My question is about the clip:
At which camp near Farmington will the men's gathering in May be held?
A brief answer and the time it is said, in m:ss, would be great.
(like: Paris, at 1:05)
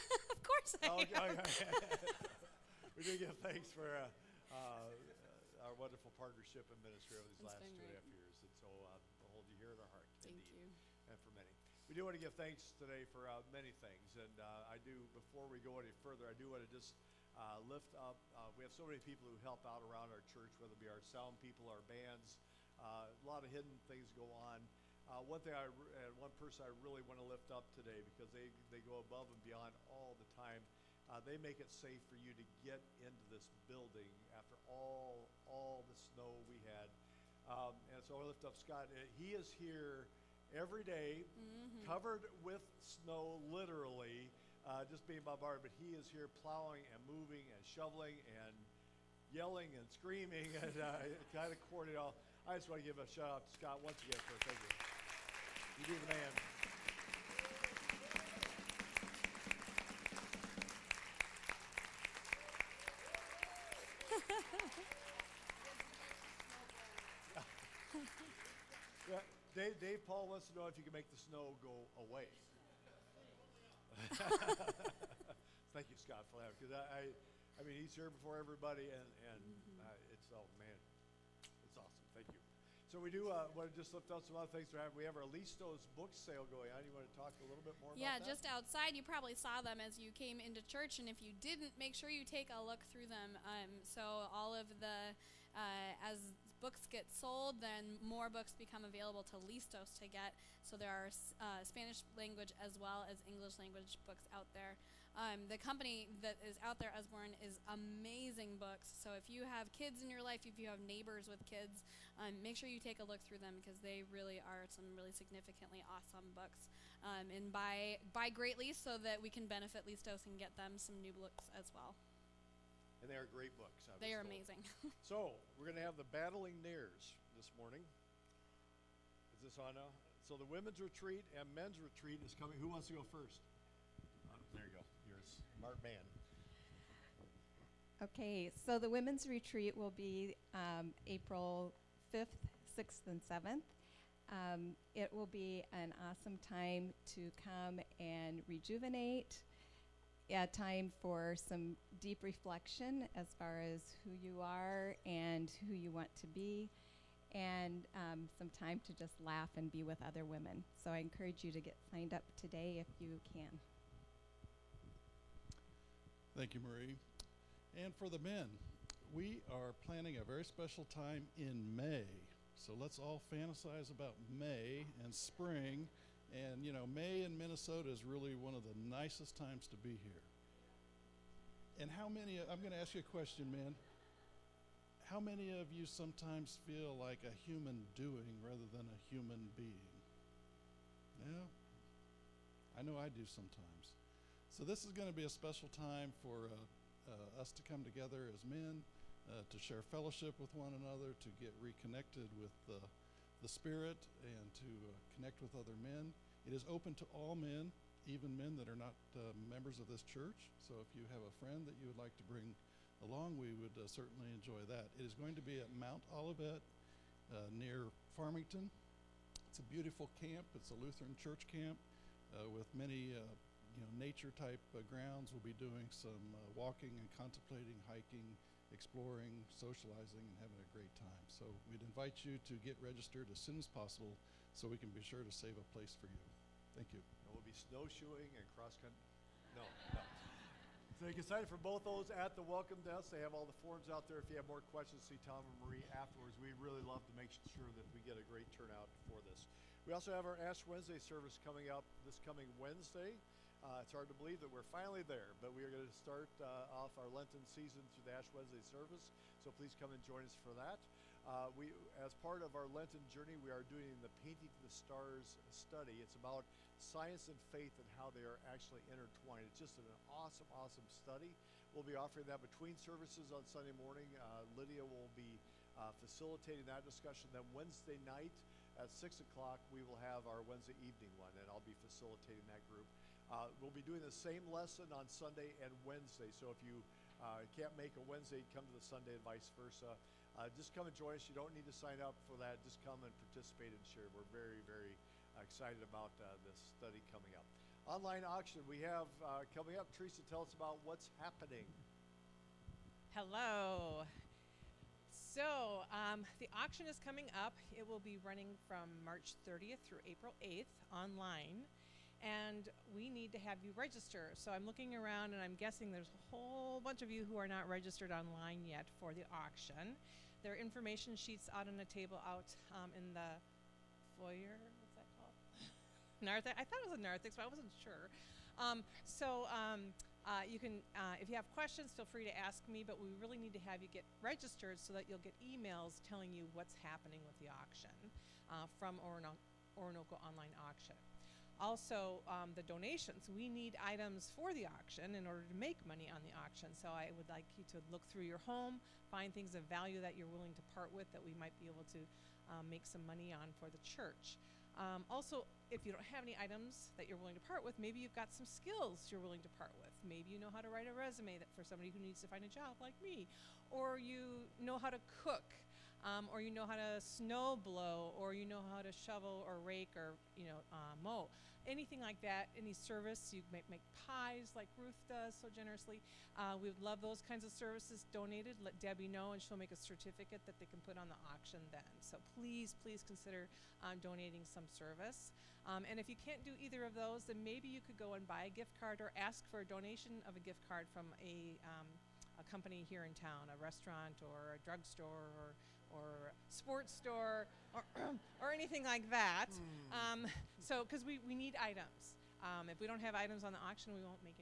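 Mount Olivet, at 3:35.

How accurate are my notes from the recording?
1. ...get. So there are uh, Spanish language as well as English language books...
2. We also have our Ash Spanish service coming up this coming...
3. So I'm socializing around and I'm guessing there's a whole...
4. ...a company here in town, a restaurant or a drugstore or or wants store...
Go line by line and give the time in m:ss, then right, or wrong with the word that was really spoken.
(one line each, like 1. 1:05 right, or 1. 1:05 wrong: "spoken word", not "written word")
1. 1:40 right
2. 4:09 wrong: "Wednesday", not "Spanish"
3. 5:14 wrong: "looking", not "socializing"
4. 6:32 wrong: "sports", not "wants".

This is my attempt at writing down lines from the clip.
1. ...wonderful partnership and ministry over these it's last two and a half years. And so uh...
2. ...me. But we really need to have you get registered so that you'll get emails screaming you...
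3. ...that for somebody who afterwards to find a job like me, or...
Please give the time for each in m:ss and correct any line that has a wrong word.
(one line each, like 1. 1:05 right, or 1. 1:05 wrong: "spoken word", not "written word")
1. 0:05 right
2. 5:32 wrong: "telling", not "screaming"
3. 6:01 wrong: "needs", not "afterwards".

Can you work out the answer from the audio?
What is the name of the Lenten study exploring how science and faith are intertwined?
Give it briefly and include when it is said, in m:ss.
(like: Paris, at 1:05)
Painting the Stars, at 4:24.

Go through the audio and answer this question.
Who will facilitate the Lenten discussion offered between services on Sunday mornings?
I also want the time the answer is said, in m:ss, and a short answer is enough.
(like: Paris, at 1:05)
Lydia, at 4:34.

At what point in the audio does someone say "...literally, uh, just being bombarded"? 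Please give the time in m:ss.
0:43.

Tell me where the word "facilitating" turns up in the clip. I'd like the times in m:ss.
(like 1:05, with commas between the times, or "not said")
4:36, 4:41.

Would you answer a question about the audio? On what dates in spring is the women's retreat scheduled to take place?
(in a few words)
April 5th, 6th, and 7th.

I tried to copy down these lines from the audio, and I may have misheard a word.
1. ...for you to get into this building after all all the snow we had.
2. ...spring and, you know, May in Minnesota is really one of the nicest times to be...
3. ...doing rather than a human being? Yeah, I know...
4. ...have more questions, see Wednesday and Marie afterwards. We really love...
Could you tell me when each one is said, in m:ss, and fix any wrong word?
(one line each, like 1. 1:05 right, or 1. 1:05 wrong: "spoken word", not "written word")
1. 0:32 right
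2. 2:55 right
3. 3:07 right
4. 4:04 wrong: "Tom", not "Wednesday".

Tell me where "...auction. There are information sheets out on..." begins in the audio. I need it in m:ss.
5:19.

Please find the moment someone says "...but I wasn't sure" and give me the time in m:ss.
5:27.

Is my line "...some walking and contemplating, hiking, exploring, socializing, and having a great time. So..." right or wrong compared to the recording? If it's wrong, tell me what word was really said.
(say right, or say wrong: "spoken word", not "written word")
right.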